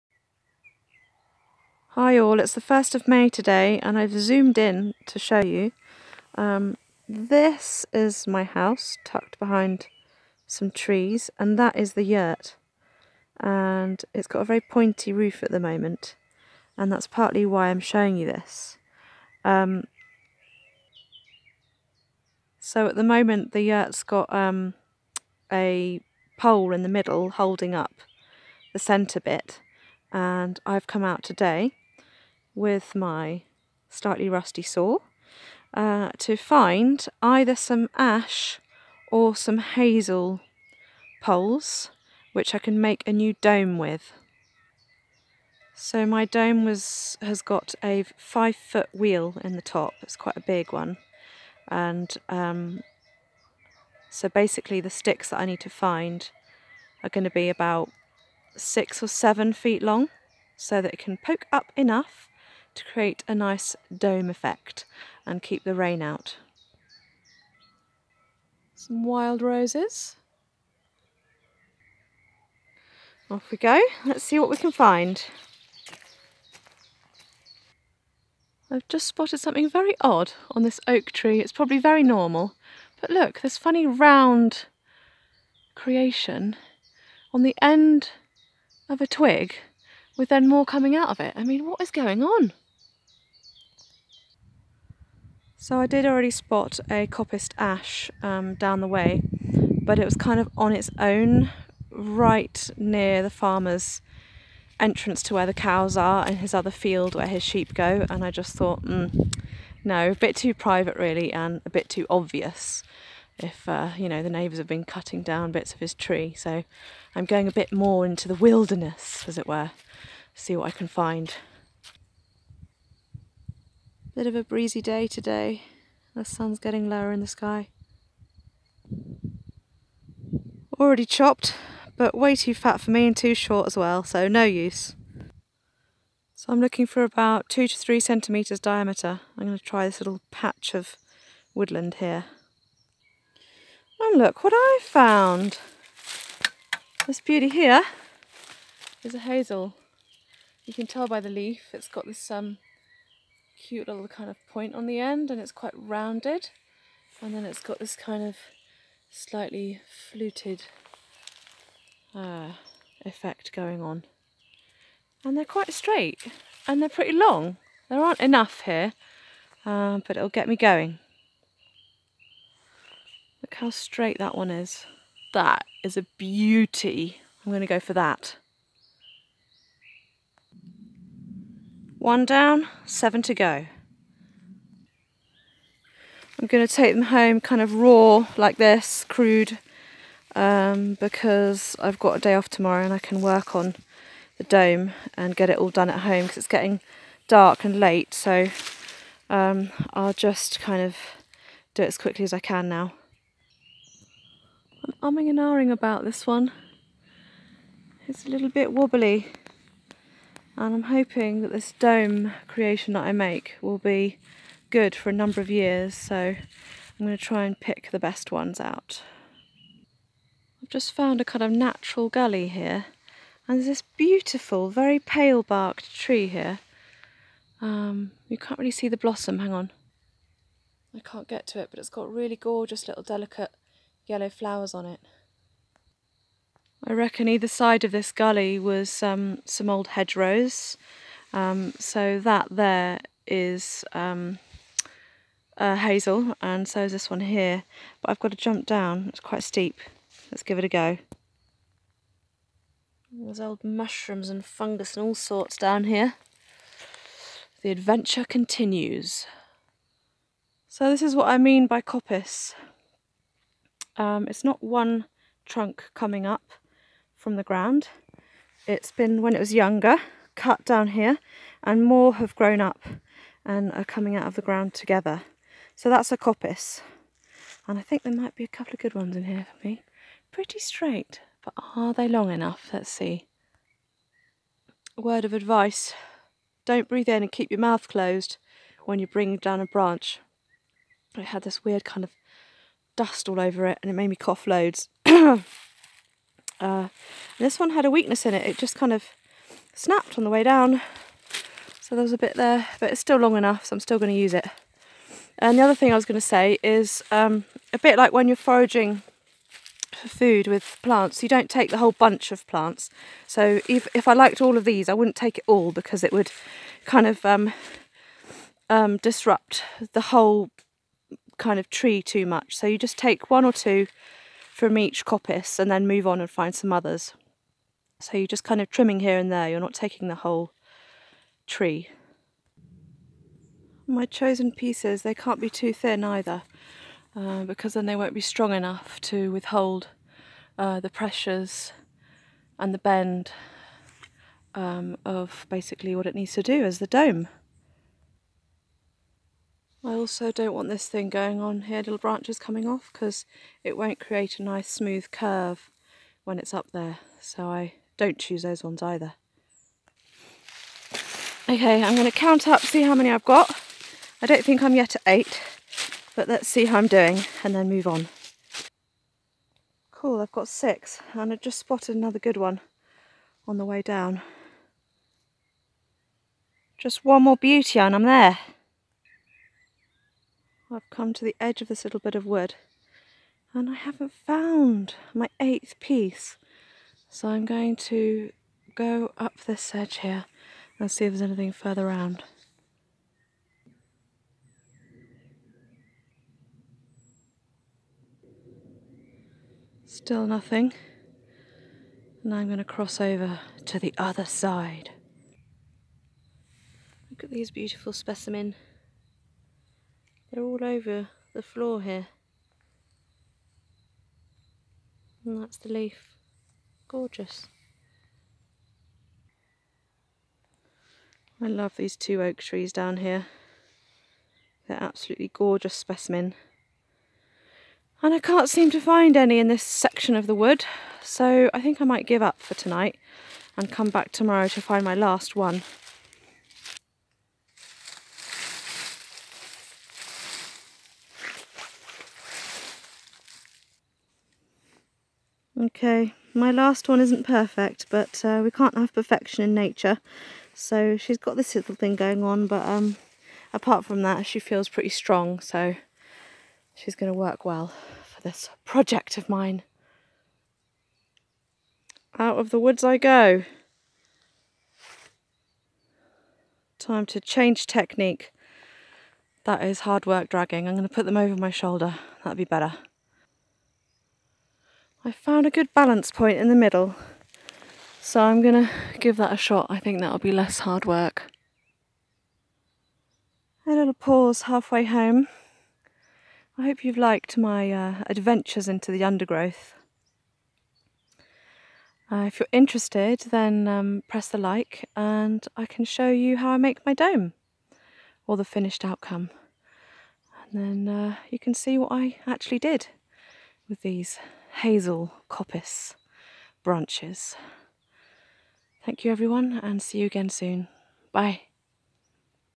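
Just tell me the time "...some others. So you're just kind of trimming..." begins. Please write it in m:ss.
5:26.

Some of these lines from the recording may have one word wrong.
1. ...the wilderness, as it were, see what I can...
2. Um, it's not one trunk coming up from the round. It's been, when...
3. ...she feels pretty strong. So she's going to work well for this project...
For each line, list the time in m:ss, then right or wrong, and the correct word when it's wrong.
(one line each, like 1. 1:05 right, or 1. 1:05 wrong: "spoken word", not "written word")
1. 1:58 right
2. 4:23 wrong: "ground", not "round"
3. 7:34 right.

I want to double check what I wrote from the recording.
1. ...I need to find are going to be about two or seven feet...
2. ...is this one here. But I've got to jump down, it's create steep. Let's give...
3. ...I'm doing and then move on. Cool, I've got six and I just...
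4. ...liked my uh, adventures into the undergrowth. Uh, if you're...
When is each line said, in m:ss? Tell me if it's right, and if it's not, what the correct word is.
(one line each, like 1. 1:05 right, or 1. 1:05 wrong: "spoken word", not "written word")
1. 0:55 wrong: "six", not "two"
2. 4:06 wrong: "quite", not "create"
3. 6:06 right
4. 8:06 right.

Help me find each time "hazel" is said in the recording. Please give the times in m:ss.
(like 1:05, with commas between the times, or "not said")
0:39, 2:29, 4:05, 8:24.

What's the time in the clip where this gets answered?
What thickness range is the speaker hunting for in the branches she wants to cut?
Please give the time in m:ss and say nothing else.
2:17.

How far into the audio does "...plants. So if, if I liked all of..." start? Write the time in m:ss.
5:12.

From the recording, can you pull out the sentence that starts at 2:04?
Bit of a breezy day today.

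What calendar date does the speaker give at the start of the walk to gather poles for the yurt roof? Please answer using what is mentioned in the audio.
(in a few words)
1st of May.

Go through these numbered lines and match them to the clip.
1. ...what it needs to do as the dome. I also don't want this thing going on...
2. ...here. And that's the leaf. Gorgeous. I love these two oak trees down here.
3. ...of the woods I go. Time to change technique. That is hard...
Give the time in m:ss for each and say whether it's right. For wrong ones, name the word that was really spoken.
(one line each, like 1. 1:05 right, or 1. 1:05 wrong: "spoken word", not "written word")
1. 5:45 right
2. 6:51 right
3. 7:42 right.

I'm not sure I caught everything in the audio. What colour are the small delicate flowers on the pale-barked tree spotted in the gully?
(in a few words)
Yellow.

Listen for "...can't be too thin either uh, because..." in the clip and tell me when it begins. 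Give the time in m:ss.
5:35.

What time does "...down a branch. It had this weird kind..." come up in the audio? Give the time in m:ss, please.
4:49.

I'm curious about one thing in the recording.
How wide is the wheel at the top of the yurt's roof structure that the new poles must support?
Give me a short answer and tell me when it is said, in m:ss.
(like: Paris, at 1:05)
5 feet, at 0:48.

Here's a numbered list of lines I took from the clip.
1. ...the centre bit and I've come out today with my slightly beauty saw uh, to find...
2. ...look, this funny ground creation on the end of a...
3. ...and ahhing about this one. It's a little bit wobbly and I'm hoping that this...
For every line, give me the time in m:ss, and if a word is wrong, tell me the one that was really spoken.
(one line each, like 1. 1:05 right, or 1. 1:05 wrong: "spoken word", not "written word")
1. 0:28 wrong: "rusty", not "beauty"
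2. 1:23 wrong: "round", not "ground"
3. 3:25 right.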